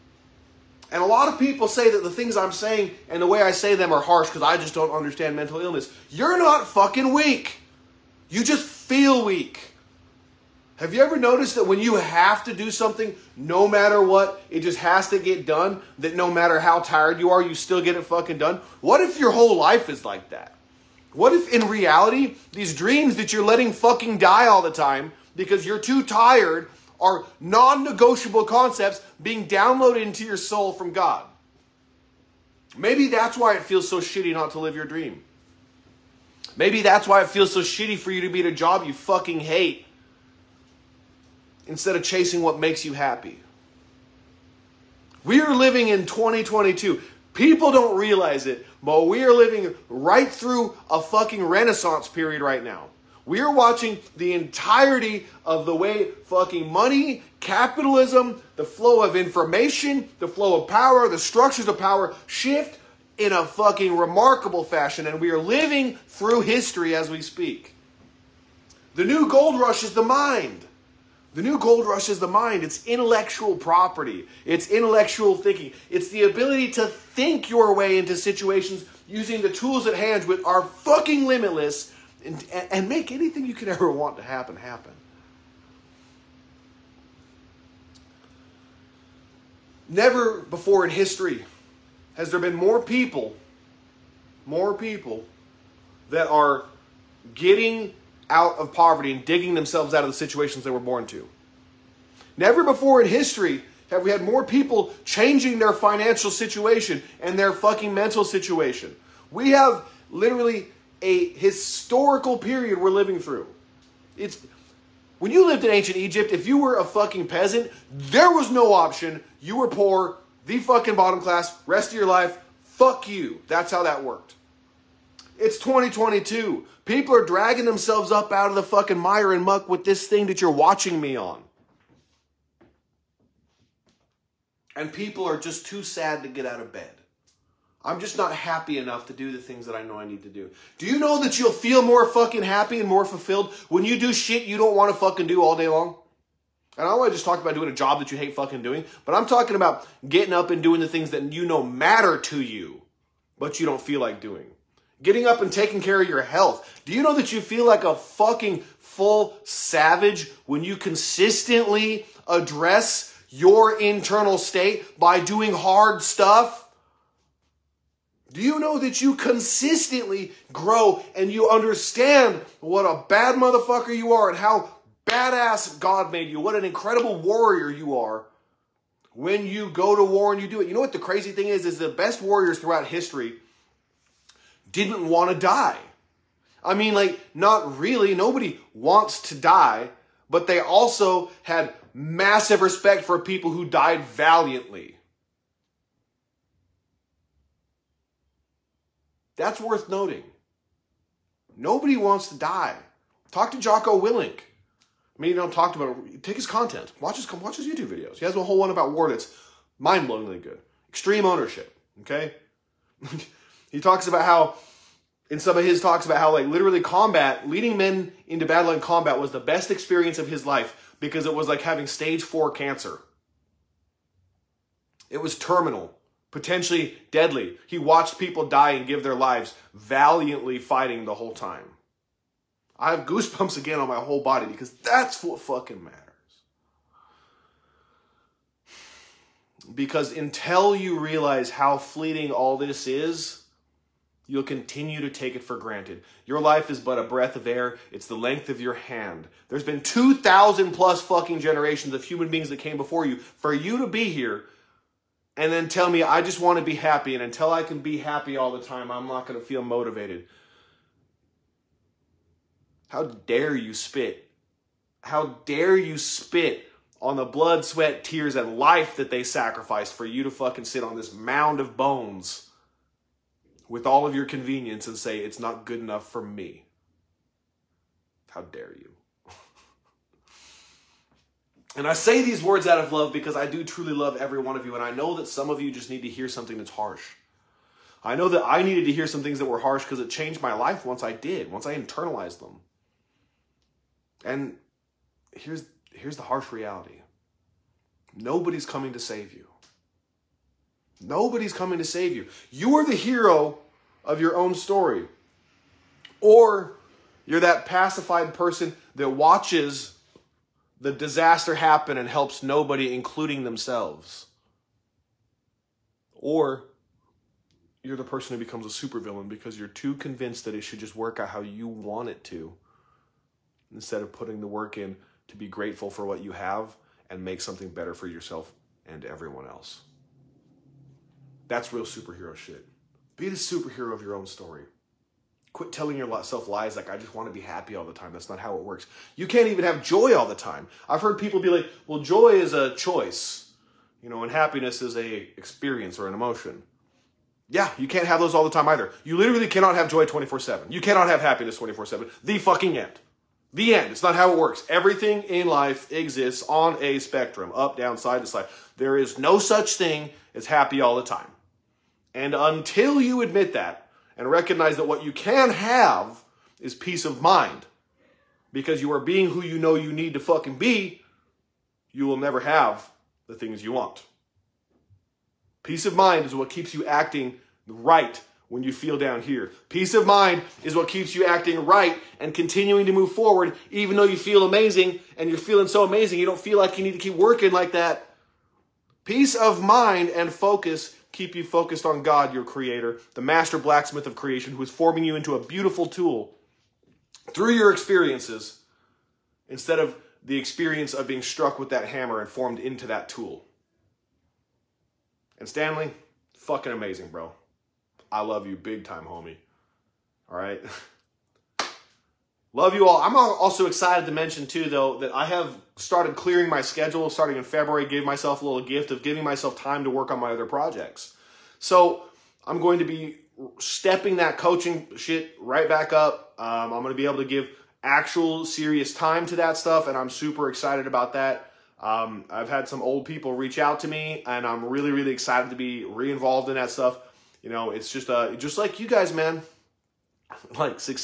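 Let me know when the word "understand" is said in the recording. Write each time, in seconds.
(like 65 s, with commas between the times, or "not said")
4 s, 171 s.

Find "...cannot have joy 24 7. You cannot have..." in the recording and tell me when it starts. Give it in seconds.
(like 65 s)
349 s.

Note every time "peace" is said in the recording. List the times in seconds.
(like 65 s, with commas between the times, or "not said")
366 s, 375 s, 379 s, 389 s.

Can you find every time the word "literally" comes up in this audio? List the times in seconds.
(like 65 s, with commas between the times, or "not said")
110 s, 216 s, 349 s.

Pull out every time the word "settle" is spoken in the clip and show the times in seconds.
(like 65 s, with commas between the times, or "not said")
not said.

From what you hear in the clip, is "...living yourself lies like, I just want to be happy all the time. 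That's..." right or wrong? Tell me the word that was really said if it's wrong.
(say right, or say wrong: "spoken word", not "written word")
wrong: "telling", not "living".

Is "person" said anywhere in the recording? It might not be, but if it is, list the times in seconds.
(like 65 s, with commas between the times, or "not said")
308 s, 318 s.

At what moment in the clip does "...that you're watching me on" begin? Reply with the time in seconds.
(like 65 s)
130 s.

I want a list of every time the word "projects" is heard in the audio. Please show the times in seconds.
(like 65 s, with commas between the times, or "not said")
420 s.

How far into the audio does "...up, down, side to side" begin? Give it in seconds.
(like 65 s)
357 s.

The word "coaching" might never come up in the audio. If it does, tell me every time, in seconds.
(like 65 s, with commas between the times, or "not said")
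424 s.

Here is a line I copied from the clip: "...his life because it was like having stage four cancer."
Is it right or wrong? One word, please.
right.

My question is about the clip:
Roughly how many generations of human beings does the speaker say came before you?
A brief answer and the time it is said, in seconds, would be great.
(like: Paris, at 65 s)
2,000 plus, at 249 s.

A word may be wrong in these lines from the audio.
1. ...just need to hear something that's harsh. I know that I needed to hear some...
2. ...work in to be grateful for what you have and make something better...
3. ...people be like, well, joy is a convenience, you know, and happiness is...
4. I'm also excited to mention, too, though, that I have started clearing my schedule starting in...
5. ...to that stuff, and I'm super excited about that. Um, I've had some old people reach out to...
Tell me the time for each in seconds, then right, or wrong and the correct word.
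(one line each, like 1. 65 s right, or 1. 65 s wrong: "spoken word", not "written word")
1. 285 s right
2. 324 s right
3. 341 s wrong: "choice", not "convenience"
4. 413 s right
5. 429 s right.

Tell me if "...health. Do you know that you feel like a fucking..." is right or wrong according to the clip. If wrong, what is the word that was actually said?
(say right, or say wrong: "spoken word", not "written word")
right.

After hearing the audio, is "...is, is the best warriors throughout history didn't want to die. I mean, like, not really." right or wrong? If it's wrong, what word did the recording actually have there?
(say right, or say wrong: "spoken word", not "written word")
right.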